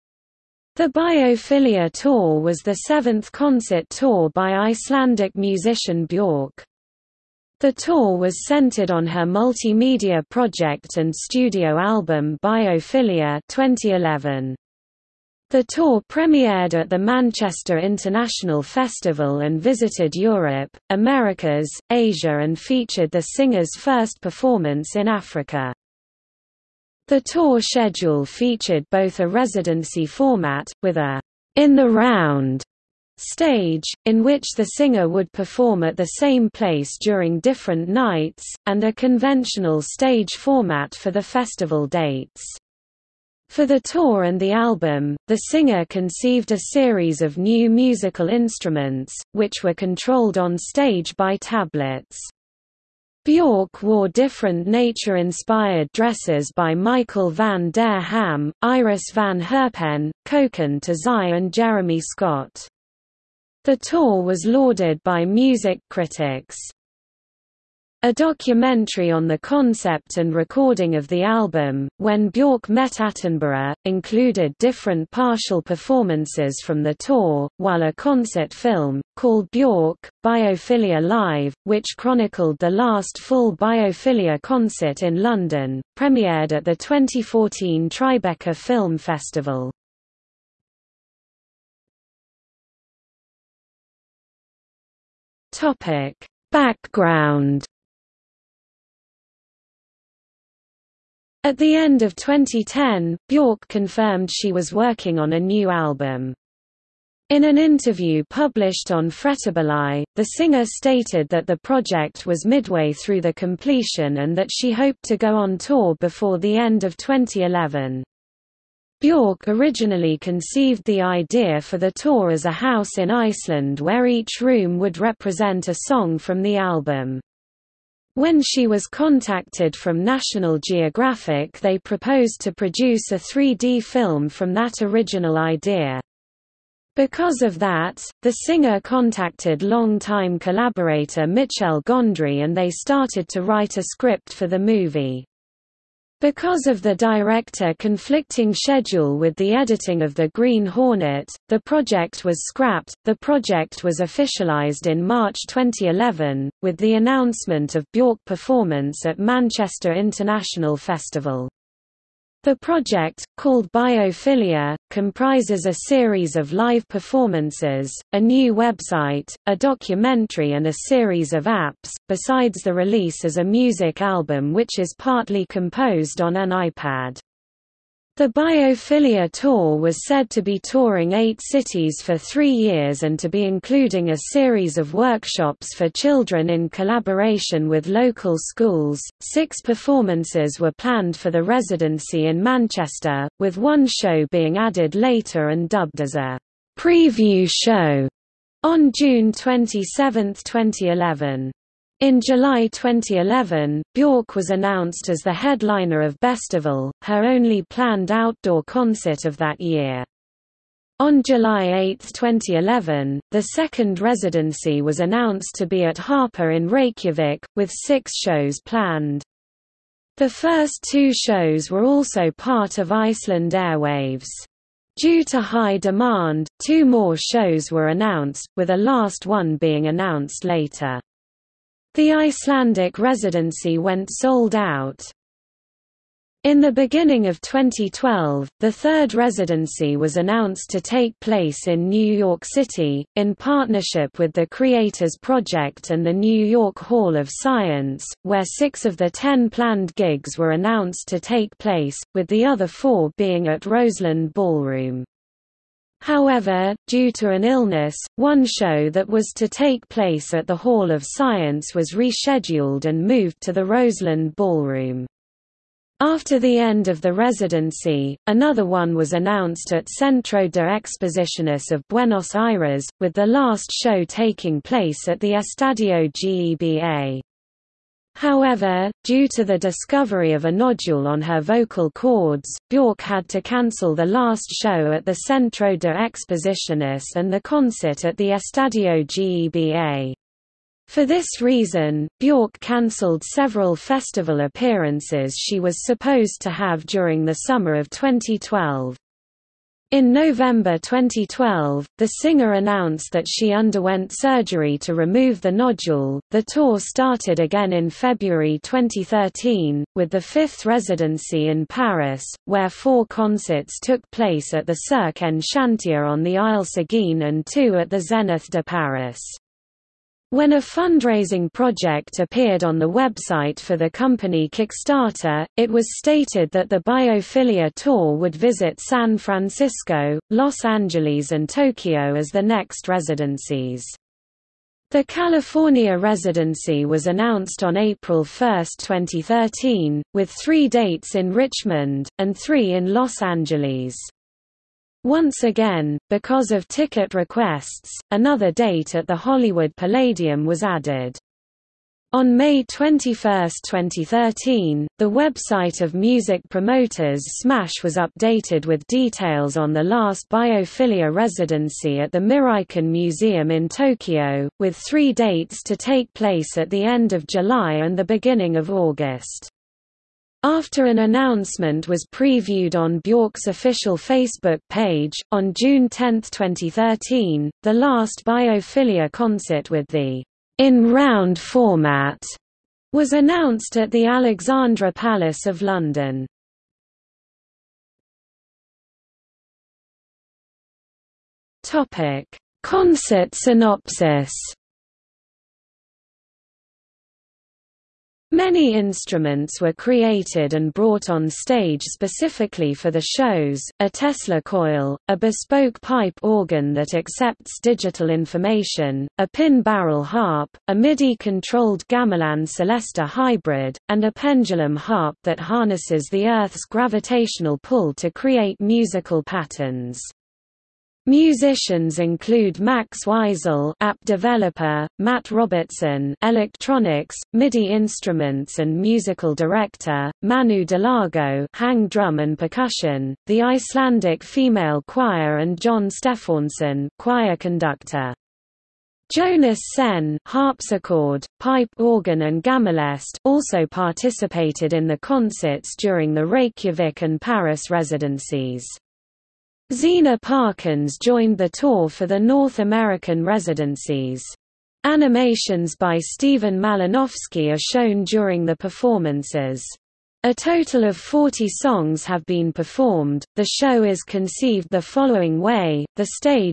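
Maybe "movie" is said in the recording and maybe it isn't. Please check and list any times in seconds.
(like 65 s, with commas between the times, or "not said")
144 s.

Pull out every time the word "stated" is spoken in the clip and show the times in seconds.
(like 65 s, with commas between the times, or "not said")
110 s, 325 s.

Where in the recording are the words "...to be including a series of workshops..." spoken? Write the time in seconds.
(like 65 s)
183 s.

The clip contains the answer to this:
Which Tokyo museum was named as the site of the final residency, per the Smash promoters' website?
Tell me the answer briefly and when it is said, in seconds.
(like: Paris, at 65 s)
Miraikan Museum, at 362 s.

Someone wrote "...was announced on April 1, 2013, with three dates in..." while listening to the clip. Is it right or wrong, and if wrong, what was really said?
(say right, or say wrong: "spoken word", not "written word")
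right.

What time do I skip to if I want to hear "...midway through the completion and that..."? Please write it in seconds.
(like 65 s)
112 s.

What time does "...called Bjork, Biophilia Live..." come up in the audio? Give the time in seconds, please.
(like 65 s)
79 s.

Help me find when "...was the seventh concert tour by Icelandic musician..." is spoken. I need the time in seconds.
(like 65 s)
2 s.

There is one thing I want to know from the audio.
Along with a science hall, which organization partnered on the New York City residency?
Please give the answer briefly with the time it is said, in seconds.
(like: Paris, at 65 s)
The Creators Project, at 244 s.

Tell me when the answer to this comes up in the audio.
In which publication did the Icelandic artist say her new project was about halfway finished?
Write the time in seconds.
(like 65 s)
109 s.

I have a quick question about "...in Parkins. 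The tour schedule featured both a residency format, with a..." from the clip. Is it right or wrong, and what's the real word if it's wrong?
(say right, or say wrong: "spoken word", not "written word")
wrong: "Africa", not "Parkins".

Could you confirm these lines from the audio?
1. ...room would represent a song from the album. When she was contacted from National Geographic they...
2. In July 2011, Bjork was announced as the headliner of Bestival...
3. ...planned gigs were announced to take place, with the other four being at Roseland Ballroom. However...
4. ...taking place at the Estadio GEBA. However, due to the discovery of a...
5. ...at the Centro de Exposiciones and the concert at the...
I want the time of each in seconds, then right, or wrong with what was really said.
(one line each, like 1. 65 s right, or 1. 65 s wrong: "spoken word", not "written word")
1. 124 s right
2. 202 s right
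3. 249 s right
4. 274 s right
5. 284 s right.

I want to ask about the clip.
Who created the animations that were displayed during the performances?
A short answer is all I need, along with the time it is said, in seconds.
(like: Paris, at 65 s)
Stephen Malinowski, at 455 s.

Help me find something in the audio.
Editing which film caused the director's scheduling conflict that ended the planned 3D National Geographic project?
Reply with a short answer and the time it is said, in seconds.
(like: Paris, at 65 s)
The Green Hornet, at 150 s.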